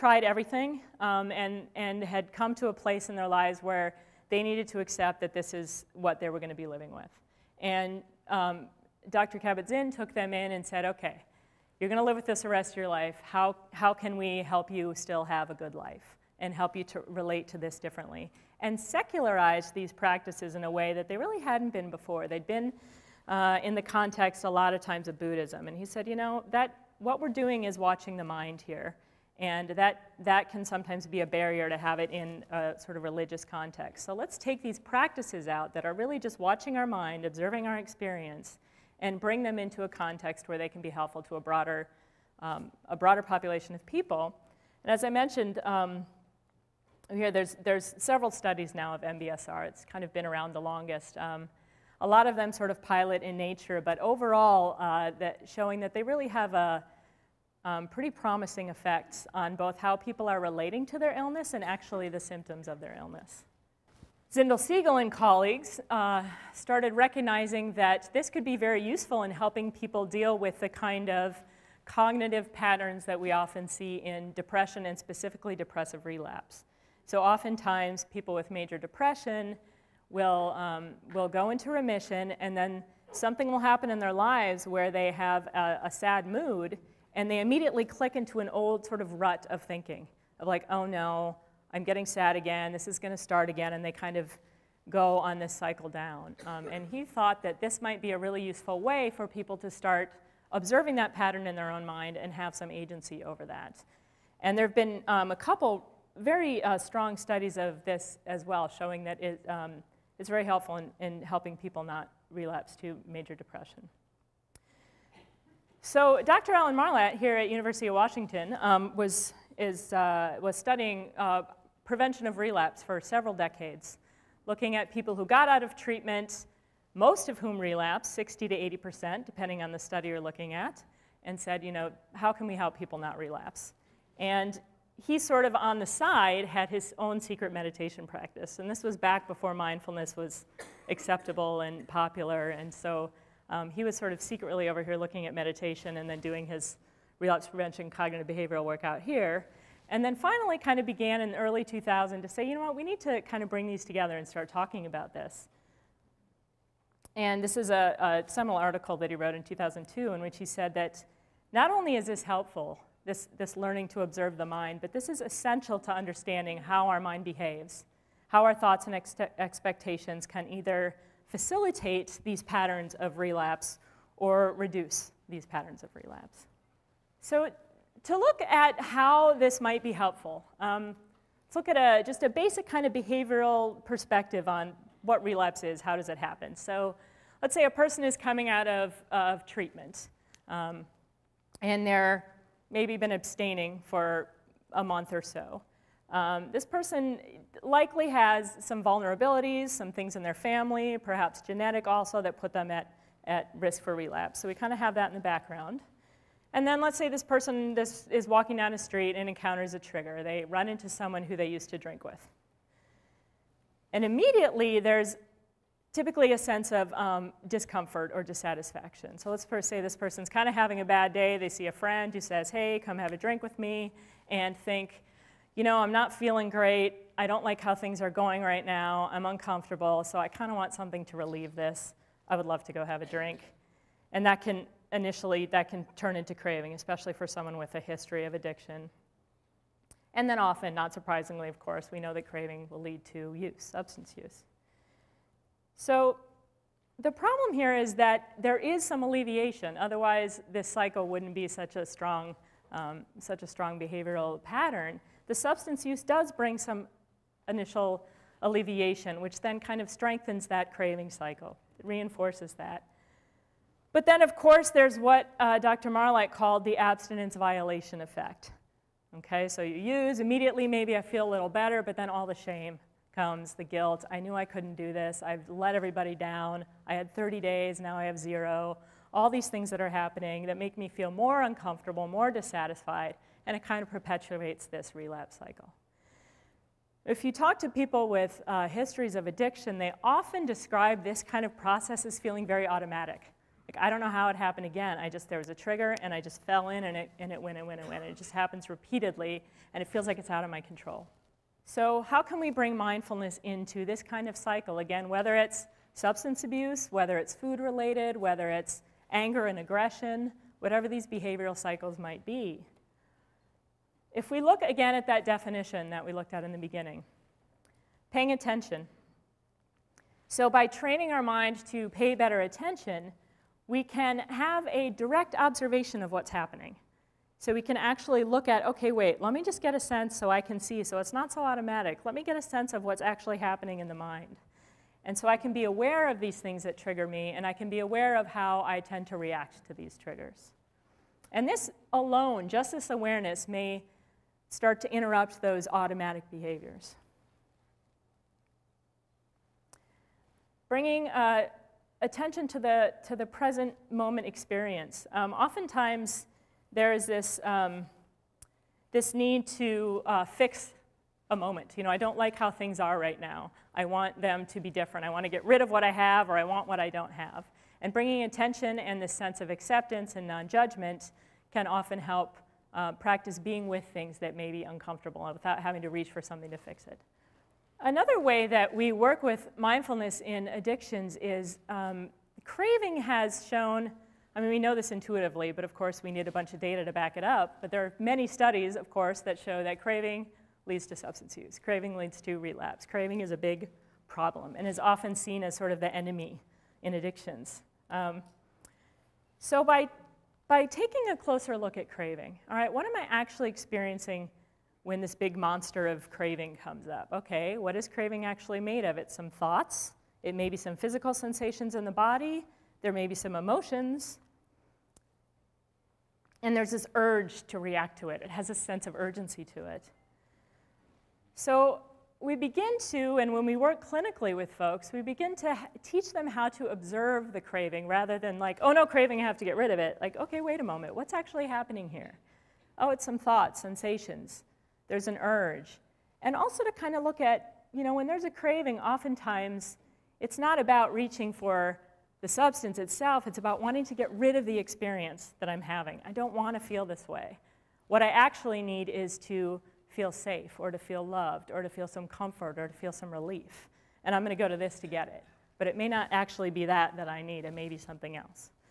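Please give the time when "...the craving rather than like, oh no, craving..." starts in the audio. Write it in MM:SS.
07:07.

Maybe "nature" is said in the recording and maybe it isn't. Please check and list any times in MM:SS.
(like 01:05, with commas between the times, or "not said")
00:53.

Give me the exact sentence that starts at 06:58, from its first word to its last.
It has a sense of urgency to it.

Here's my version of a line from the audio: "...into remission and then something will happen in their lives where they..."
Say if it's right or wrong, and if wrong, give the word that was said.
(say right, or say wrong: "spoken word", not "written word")
right.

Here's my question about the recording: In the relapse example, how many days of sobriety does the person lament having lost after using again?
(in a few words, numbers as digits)
30.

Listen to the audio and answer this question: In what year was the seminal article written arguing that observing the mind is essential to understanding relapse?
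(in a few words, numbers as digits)
2002.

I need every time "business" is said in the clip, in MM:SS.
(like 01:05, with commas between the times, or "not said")
not said.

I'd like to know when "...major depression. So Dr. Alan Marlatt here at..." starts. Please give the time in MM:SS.
01:53.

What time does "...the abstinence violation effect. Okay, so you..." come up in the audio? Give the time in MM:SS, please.
04:26.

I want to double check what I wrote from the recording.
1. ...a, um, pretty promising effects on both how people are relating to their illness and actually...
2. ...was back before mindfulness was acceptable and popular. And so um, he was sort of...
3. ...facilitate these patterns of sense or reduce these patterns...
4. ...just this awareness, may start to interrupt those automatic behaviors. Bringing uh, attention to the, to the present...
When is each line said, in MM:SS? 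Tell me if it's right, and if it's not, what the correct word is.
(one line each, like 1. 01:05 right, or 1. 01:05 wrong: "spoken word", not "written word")
1. 00:56 right
2. 02:18 right
3. 02:51 wrong: "relapse", not "sense"
4. 05:42 right.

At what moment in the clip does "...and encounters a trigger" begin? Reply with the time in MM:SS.
03:29.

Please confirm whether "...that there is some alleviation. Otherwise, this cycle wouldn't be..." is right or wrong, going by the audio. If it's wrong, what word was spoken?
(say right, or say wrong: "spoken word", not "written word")
right.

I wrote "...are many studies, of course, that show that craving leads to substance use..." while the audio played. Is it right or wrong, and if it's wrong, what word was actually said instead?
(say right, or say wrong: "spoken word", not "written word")
right.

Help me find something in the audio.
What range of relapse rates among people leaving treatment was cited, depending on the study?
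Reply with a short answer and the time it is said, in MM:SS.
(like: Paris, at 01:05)
60 to 80%, at 02:08.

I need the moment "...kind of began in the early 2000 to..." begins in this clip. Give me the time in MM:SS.
02:30.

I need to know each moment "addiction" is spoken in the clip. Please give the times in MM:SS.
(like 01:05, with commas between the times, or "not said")
03:58, 04:49, 06:20, 06:36.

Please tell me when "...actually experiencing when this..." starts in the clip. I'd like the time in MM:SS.
06:43.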